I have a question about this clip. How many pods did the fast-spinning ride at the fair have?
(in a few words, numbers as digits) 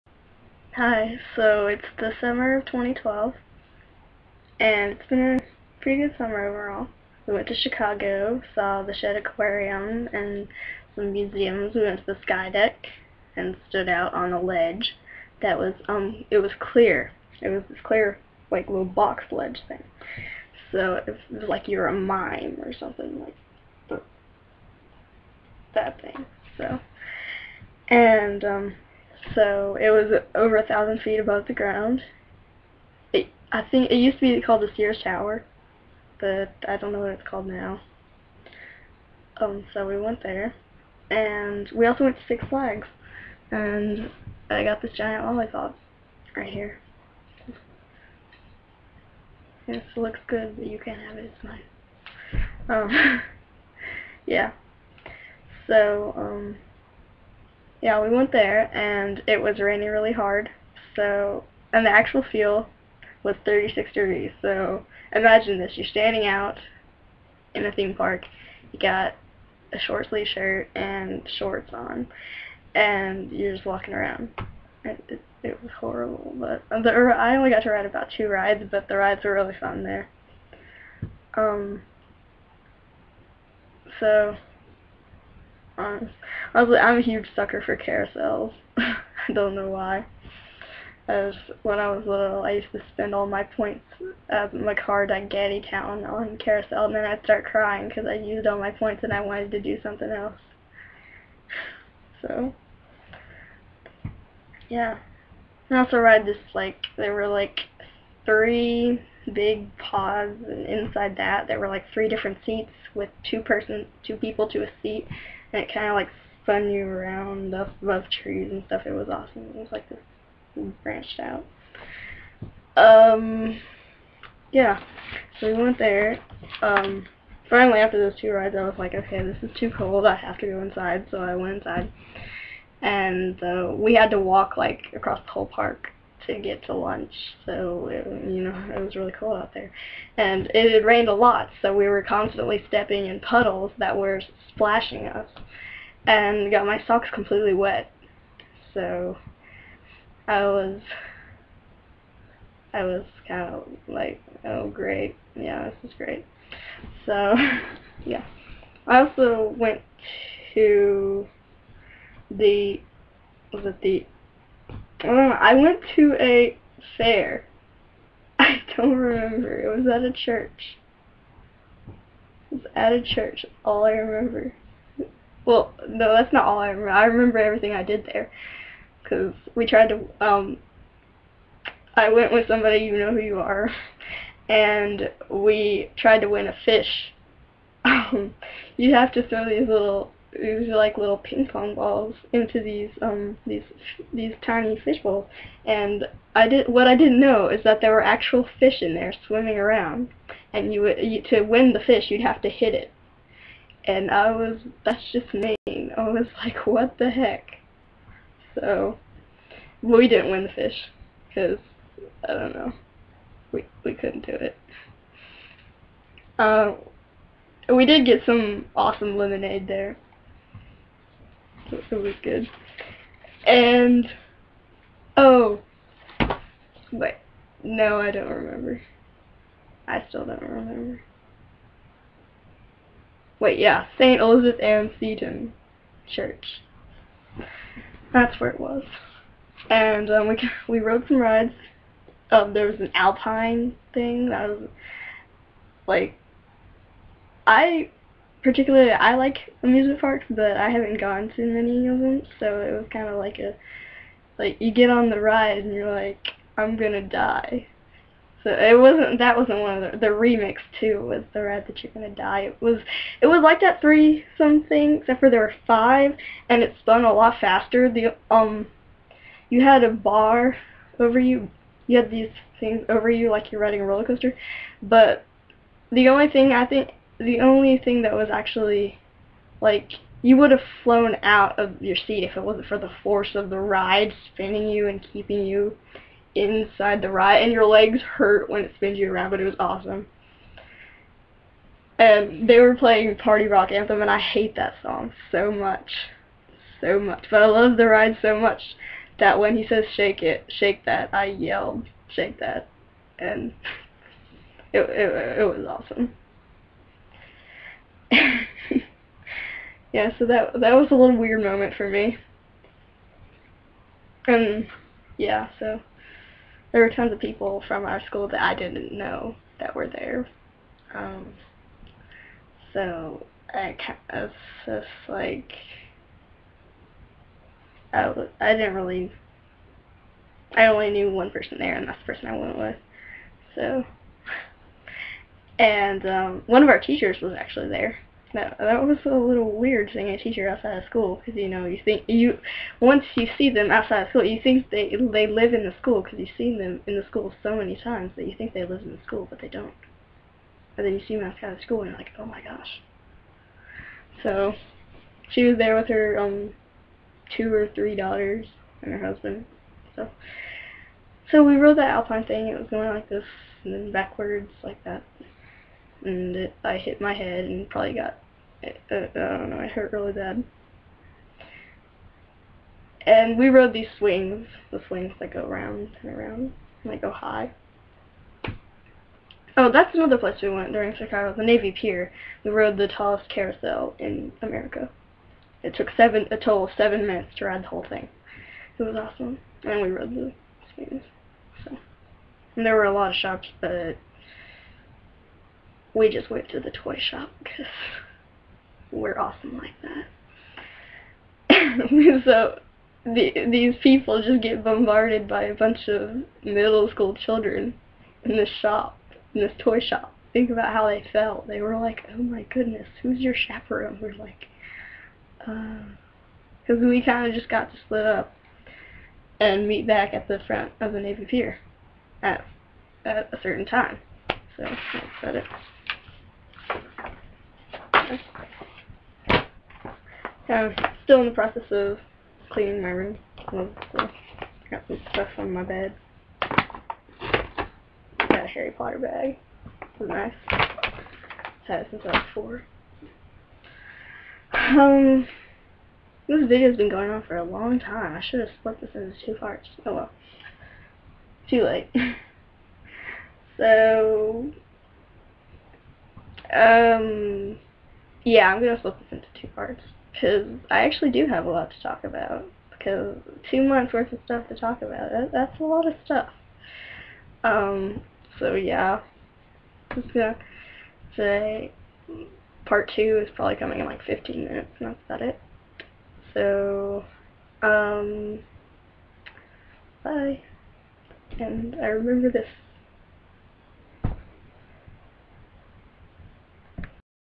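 5.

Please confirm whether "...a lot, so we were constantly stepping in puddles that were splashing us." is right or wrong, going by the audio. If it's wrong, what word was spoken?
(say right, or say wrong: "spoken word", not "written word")
right.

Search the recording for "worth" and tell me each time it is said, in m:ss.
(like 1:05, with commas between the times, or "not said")
7:43.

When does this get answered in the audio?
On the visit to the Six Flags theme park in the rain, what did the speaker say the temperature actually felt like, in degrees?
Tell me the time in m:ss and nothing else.
1:03.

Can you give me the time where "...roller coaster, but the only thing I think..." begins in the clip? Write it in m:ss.
4:33.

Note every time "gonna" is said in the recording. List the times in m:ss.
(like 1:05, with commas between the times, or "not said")
4:16, 4:21, 7:50.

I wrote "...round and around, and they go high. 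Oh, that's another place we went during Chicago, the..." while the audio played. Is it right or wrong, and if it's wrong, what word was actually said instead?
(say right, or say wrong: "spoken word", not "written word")
right.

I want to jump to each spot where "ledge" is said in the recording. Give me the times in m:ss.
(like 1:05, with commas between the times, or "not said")
0:14, 0:19.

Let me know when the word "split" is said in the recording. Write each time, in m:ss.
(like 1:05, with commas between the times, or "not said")
6:57, 7:28, 7:38.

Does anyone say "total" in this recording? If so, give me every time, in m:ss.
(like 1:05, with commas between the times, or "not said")
6:26.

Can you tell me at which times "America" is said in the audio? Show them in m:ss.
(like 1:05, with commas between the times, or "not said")
6:24.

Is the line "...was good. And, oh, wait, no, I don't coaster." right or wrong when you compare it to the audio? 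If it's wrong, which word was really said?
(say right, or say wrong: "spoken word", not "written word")
wrong: "remember", not "coaster".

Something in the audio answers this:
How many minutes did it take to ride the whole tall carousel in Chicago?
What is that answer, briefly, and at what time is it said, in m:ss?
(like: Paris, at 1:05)
7, at 6:26.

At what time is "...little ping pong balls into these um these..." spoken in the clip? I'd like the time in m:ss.
3:10.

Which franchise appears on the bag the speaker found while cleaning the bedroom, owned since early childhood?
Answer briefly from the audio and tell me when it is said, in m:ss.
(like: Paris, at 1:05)
Harry Potter, at 7:18.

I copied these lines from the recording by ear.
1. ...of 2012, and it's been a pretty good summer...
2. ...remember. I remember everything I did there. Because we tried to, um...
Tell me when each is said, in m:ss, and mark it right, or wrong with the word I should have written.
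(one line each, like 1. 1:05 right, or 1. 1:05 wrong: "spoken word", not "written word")
1. 0:02 right
2. 2:56 right.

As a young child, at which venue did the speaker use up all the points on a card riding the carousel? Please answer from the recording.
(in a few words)
Gatti Town.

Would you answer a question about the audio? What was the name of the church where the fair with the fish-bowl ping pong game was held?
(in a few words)
St. Elizabeth Ann Seton Church.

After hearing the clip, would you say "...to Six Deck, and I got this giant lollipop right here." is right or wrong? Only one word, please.
wrong.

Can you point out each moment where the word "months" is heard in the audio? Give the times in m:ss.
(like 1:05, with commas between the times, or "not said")
7:43.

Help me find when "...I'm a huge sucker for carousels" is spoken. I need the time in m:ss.
1:26.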